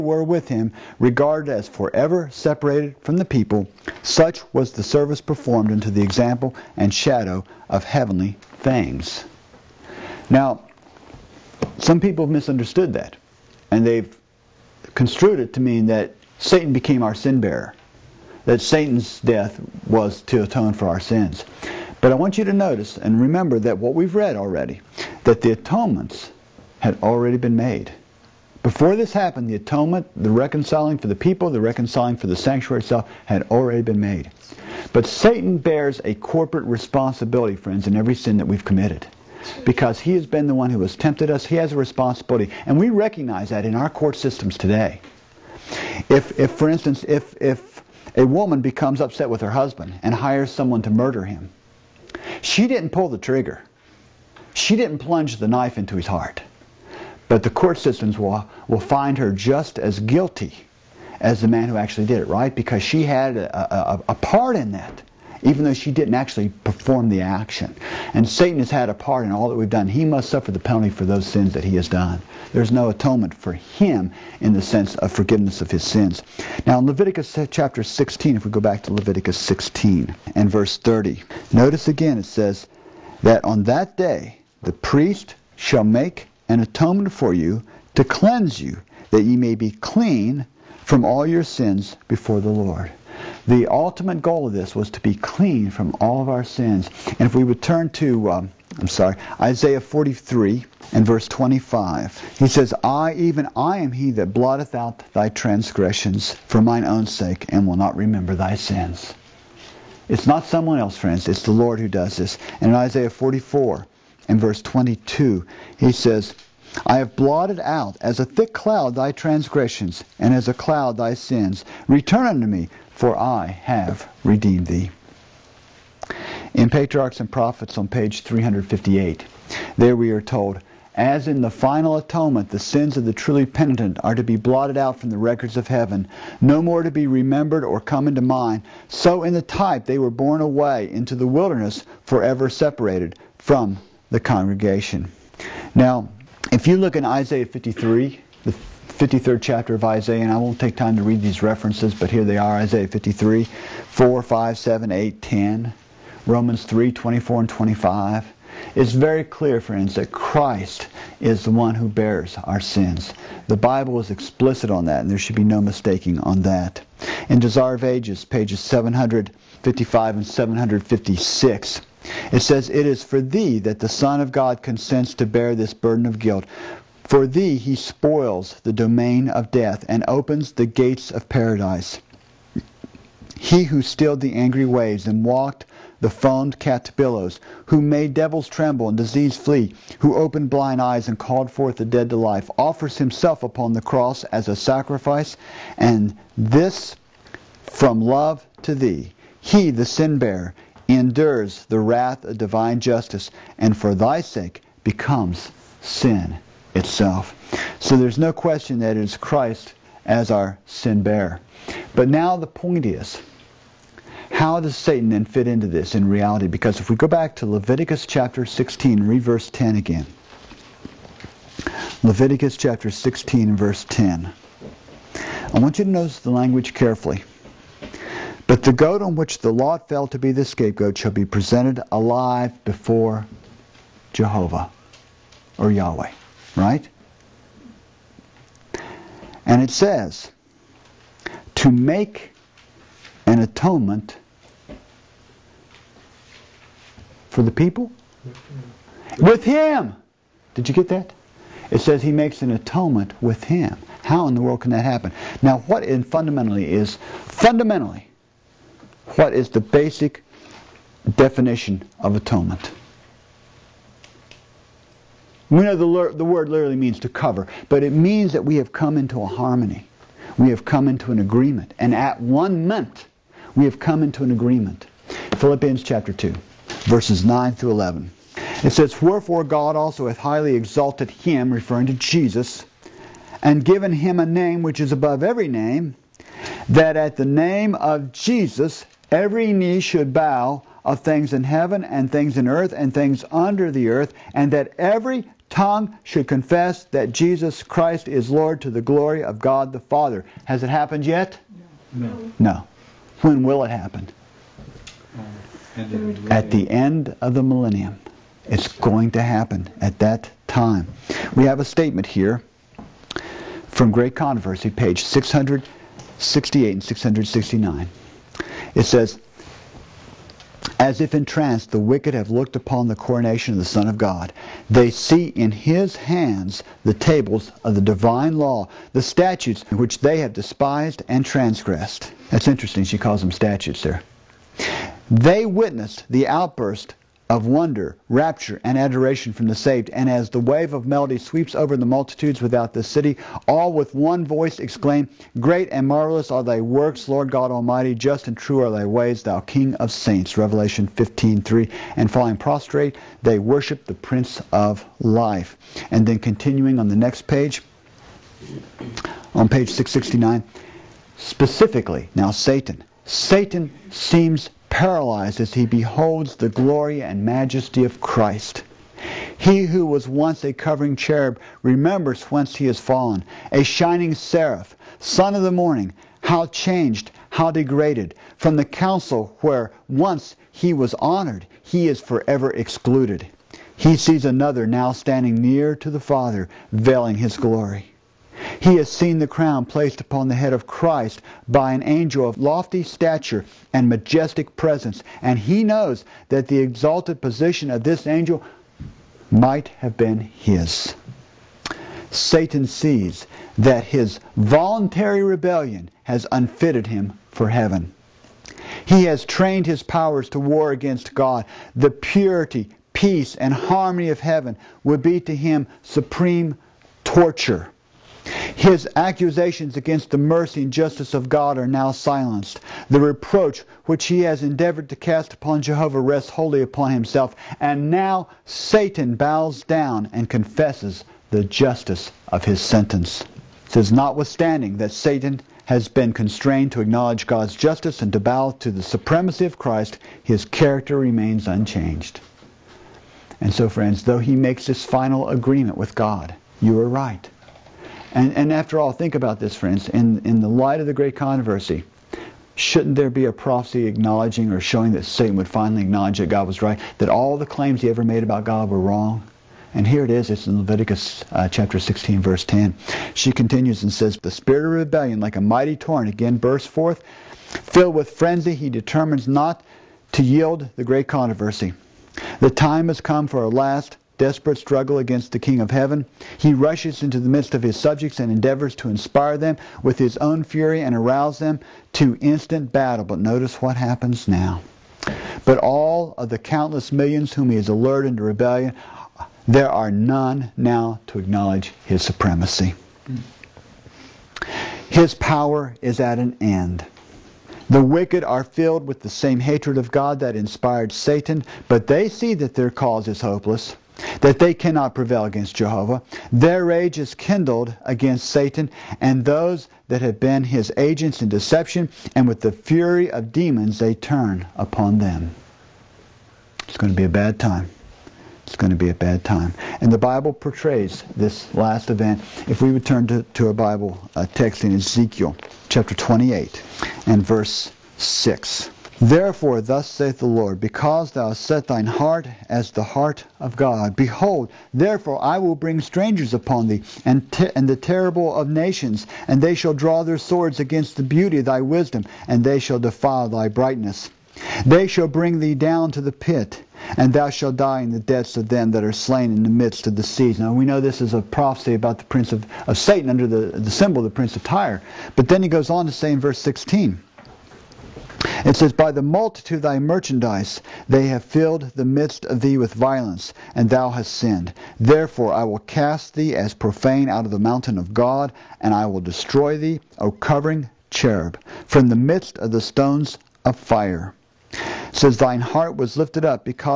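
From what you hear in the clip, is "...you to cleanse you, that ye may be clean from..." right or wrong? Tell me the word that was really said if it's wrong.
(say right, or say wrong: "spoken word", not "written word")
right.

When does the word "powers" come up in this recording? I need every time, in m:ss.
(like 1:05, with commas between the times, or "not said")
6:49, 8:15.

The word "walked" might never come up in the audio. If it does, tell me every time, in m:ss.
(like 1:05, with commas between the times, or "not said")
3:05.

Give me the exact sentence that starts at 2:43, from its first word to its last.
The Bible is explicit on that, and there should be no mistaking on that.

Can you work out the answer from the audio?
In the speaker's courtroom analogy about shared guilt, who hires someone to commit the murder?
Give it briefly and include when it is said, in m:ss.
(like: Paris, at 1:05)
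A woman, at 0:48.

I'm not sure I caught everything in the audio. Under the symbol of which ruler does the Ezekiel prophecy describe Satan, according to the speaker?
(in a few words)
Prince of Tyre.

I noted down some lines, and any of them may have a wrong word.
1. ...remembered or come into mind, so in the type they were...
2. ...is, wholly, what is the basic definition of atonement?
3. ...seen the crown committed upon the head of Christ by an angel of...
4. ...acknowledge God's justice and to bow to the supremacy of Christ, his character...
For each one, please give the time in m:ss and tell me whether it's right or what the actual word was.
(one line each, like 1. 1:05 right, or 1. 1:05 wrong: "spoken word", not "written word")
1. 2:17 right
2. 4:16 wrong: "fundamentally", not "wholly"
3. 6:28 wrong: "placed", not "committed"
4. 7:16 right.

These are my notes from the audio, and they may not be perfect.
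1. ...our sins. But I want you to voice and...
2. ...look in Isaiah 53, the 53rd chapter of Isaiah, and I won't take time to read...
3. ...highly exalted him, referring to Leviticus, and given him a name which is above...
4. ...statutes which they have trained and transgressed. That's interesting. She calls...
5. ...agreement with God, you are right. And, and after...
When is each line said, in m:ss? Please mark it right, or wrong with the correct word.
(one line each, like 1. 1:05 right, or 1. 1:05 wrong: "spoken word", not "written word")
1. 0:20 wrong: "notice", not "voice"
2. 2:26 right
3. 4:40 wrong: "Jesus", not "Leviticus"
4. 5:29 wrong: "despised", not "trained"
5. 7:25 right.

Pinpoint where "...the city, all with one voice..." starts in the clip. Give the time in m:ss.
5:42.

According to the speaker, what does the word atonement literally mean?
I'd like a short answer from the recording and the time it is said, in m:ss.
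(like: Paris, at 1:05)
To cover, at 4:27.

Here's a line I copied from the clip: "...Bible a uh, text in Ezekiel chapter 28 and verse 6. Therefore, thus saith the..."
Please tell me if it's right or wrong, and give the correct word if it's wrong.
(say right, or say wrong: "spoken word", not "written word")
right.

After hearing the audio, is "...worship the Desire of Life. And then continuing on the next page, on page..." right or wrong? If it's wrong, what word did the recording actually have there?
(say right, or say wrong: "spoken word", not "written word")
wrong: "Prince", not "Desire".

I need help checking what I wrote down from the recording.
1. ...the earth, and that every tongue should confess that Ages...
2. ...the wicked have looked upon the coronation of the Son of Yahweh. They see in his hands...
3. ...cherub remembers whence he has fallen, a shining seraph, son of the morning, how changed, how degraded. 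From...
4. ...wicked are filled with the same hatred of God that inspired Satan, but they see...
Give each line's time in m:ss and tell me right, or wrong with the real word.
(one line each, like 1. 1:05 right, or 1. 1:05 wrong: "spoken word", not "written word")
1. 4:53 wrong: "Jesus", not "Ages"
2. 5:21 wrong: "God", not "Yahweh"
3. 6:10 right
4. 8:17 right.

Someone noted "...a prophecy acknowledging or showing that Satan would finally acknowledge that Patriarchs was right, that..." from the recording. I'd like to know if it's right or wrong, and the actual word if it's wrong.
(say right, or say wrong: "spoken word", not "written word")
wrong: "God", not "Patriarchs".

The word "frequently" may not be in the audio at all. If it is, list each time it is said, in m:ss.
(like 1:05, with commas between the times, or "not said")
not said.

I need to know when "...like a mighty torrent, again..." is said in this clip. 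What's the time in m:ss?
7:45.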